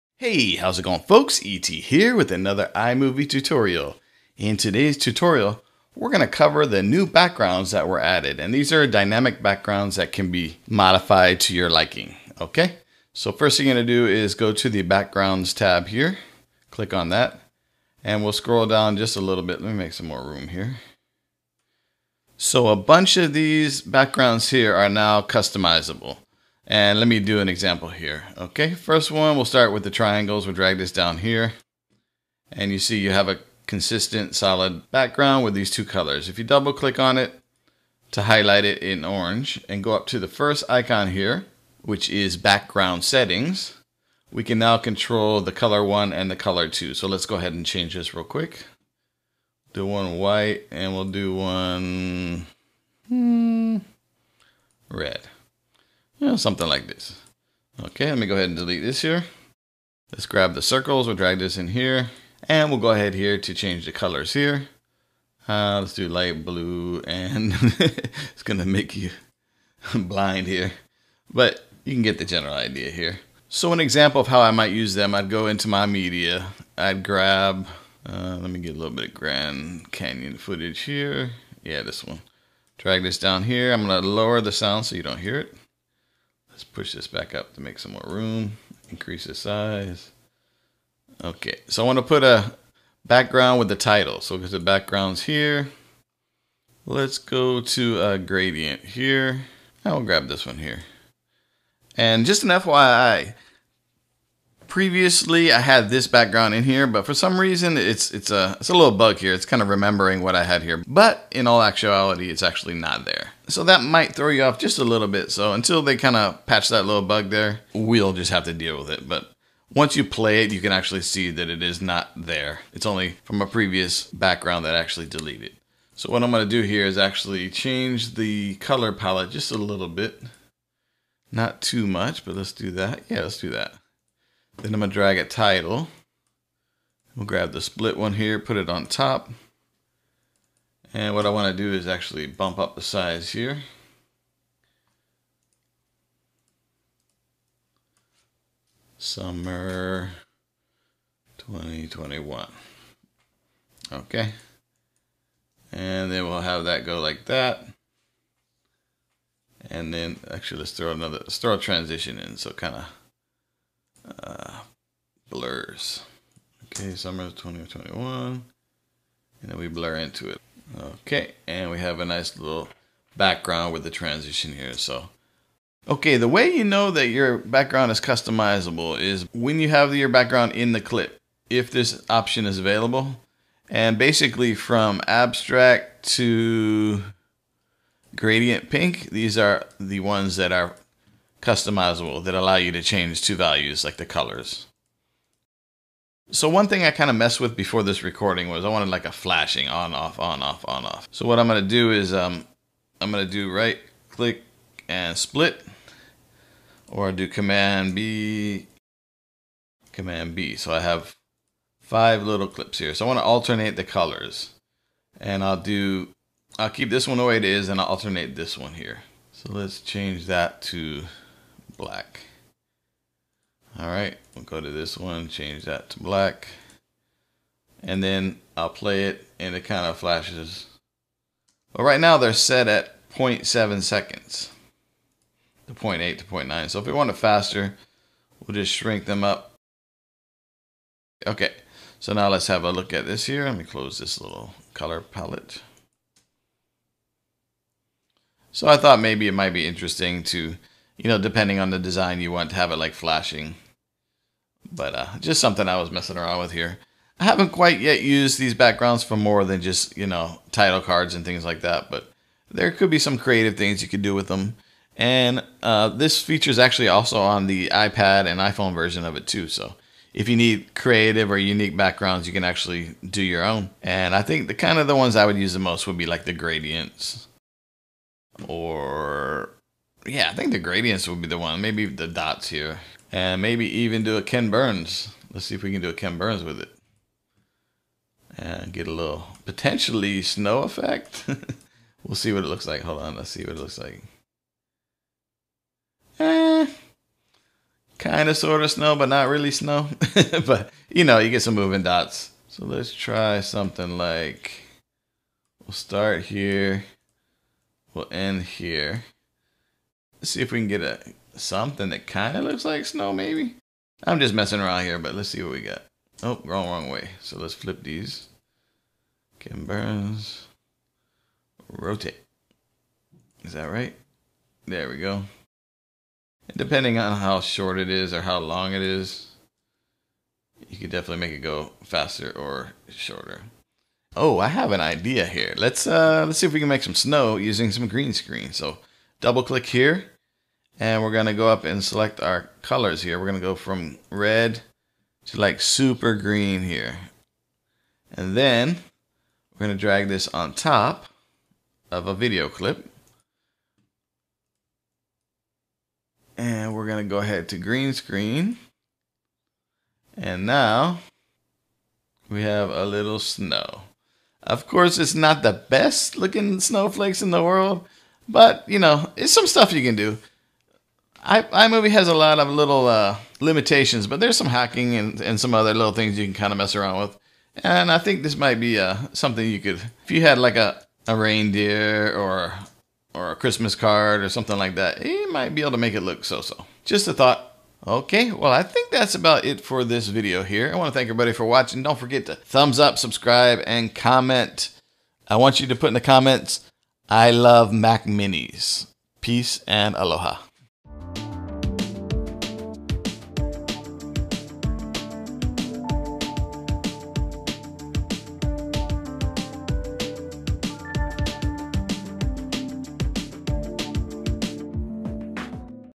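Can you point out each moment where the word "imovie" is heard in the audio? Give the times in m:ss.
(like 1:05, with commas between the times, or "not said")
0:02, 6:11.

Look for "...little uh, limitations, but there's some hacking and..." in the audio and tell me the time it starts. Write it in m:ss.
6:12.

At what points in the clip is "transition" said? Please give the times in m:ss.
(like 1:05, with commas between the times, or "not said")
2:41, 2:53.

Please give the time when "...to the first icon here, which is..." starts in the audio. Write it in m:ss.
0:40.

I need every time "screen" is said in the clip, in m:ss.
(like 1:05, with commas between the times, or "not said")
5:38, 5:57.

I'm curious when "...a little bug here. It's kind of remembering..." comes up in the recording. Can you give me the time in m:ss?
1:48.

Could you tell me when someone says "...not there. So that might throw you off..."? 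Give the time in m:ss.
1:52.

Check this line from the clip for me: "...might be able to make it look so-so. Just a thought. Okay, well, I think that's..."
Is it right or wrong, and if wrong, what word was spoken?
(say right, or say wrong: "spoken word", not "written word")
right.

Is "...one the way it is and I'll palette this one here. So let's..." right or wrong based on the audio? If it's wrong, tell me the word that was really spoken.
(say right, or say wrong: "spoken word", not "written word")
wrong: "alternate", not "palette".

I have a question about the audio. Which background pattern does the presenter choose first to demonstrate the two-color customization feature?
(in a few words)
Triangles.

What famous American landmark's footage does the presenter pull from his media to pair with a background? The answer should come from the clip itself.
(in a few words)
Grand Canyon.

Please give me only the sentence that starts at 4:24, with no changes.
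And uh, this feature is actually also on the iPad and iPhone version of it too.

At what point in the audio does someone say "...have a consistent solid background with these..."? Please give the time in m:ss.
0:33.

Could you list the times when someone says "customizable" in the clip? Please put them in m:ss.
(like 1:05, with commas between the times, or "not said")
0:25, 2:57, 3:11.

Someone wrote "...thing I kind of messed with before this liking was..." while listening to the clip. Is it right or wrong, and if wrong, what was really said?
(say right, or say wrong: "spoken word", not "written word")
wrong: "recording", not "liking".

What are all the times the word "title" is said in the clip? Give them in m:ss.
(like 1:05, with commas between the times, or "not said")
1:33, 2:15, 4:20.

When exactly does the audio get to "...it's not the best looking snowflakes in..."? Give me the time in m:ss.
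6:04.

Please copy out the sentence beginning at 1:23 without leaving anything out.
I'm gonna lower the sound so you don't hear it.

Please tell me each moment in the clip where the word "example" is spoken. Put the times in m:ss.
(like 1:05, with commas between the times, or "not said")
0:27, 1:13.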